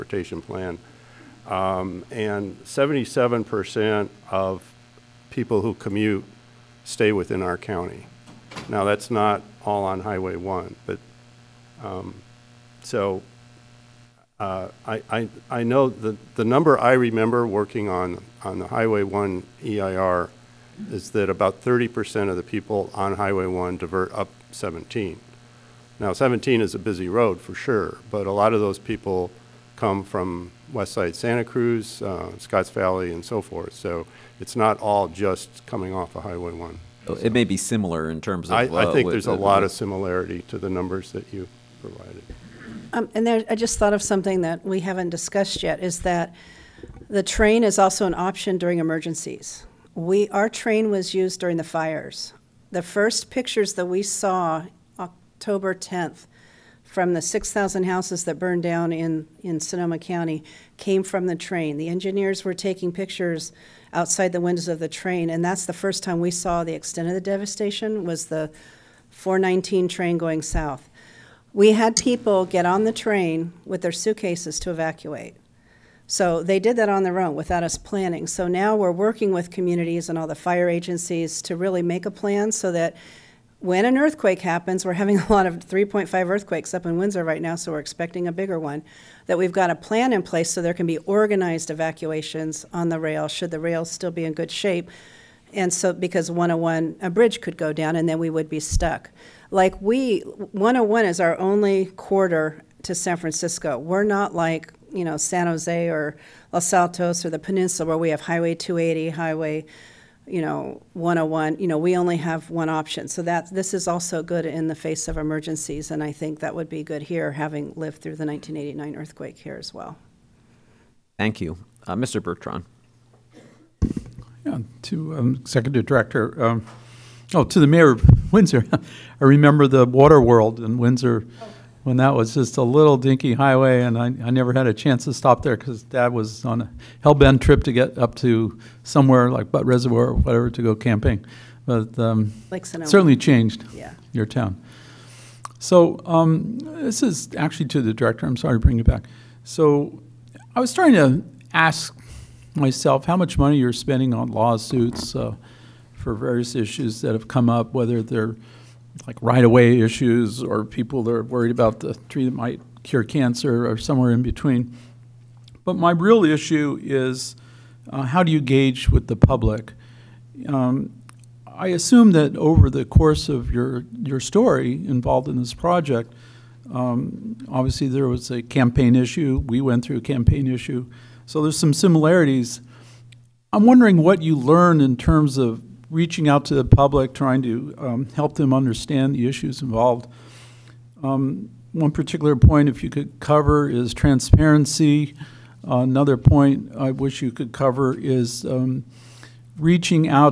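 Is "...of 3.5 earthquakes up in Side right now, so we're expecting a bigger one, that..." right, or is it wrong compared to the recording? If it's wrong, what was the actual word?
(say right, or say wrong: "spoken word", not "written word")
wrong: "Windsor", not "Side".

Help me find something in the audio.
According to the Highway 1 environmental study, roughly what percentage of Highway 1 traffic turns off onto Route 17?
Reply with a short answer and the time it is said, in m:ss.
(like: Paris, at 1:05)
30%, at 0:21.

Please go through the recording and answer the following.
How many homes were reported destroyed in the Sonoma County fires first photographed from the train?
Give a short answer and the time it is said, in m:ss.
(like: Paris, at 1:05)
6,000, at 0:57.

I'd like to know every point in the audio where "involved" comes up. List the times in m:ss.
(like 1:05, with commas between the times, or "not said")
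2:54, 3:09.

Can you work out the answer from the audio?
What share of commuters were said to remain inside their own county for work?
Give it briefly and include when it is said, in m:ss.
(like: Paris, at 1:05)
77%, at 0:02.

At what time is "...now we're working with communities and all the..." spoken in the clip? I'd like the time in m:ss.
1:18.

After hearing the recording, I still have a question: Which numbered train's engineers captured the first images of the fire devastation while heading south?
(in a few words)
419.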